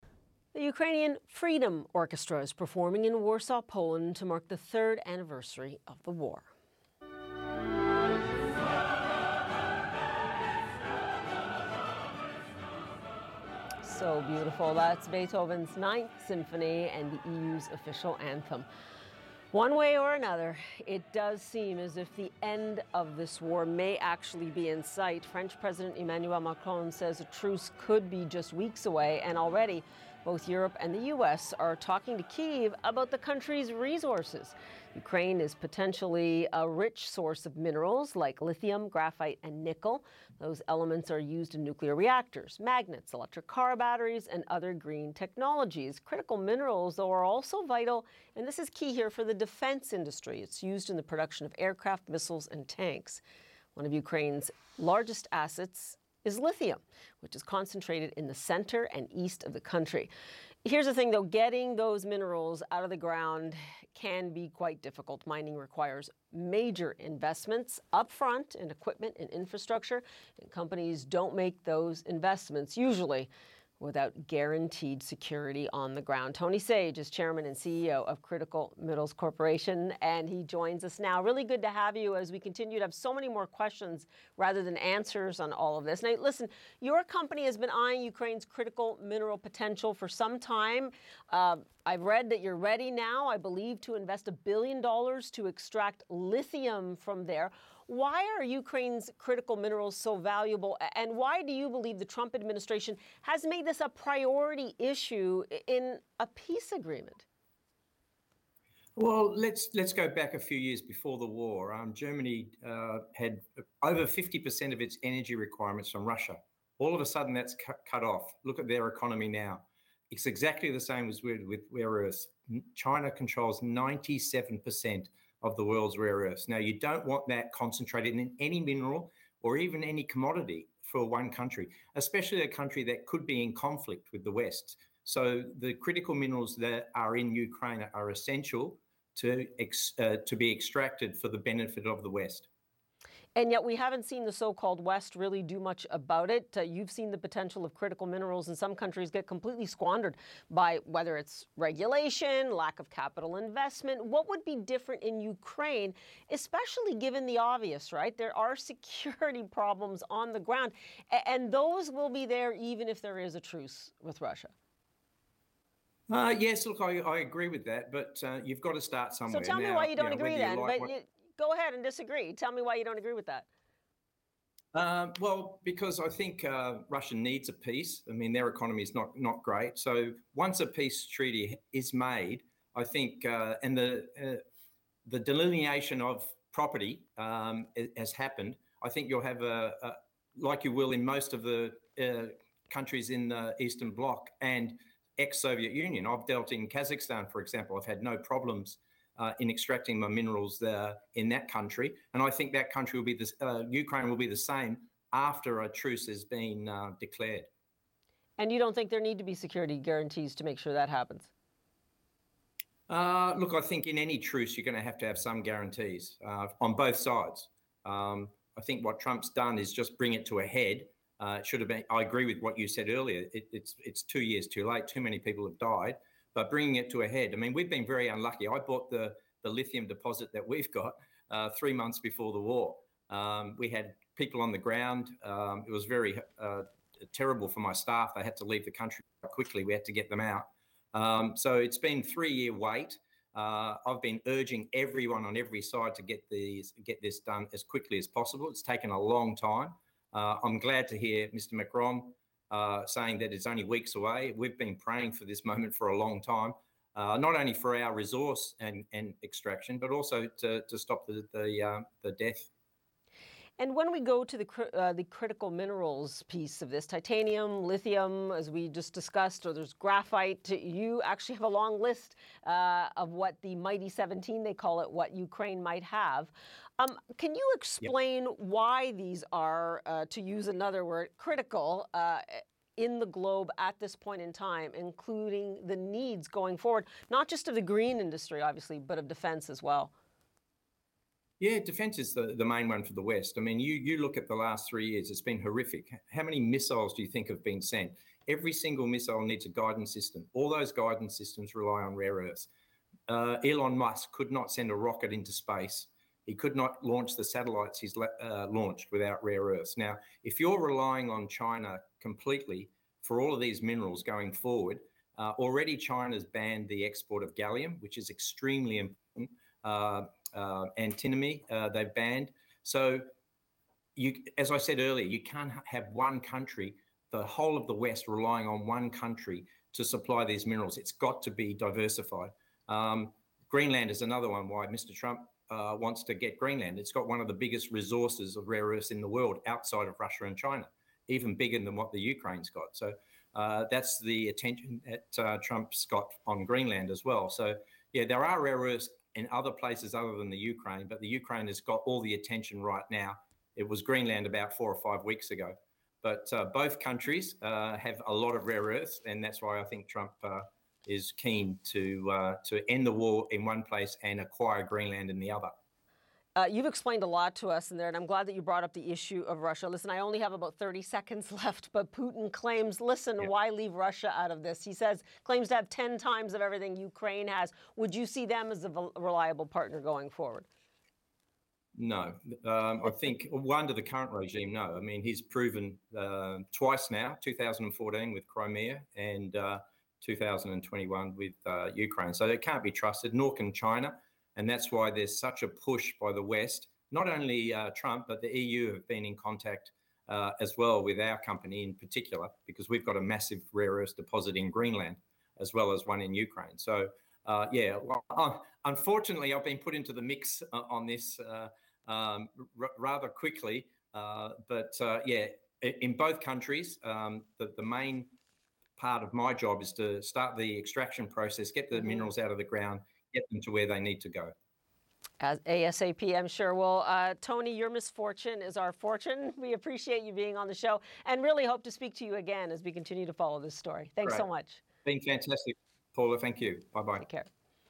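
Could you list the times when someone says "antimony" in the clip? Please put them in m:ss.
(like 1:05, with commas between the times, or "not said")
5:20.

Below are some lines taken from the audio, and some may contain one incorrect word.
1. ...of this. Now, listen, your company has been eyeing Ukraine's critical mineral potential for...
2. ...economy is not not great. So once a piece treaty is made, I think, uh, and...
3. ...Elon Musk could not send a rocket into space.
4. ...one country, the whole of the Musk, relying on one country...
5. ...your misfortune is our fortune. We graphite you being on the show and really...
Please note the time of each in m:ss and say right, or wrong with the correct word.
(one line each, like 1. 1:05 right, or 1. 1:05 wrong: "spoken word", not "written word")
1. 1:25 right
2. 2:58 wrong: "peace", not "piece"
3. 5:03 right
4. 5:25 wrong: "West", not "Musk"
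5. 7:07 wrong: "appreciate", not "graphite".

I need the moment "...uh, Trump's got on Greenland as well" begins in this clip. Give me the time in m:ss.
5:45.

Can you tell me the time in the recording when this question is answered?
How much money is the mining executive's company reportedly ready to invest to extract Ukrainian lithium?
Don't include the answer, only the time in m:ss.
1:34.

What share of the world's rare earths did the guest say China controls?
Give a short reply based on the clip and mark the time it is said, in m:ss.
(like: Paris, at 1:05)
97%, at 2:03.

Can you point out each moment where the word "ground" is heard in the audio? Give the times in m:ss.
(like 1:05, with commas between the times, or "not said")
1:02, 1:16, 2:40, 3:54, 7:02.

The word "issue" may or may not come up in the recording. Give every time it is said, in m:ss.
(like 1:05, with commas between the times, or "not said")
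1:44, 6:08.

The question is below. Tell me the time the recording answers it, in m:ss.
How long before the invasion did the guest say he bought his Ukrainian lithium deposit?
3:51.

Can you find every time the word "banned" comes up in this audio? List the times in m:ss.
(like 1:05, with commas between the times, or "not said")
5:16, 5:21.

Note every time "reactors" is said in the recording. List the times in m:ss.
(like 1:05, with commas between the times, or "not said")
0:41.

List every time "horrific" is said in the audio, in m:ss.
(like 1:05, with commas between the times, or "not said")
4:55.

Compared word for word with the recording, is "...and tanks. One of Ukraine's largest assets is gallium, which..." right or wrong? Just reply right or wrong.
wrong.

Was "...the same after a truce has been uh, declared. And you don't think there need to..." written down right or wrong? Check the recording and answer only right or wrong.
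right.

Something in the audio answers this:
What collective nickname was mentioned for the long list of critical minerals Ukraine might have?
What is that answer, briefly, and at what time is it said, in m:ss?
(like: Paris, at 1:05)
the Mighty 17, at 4:33.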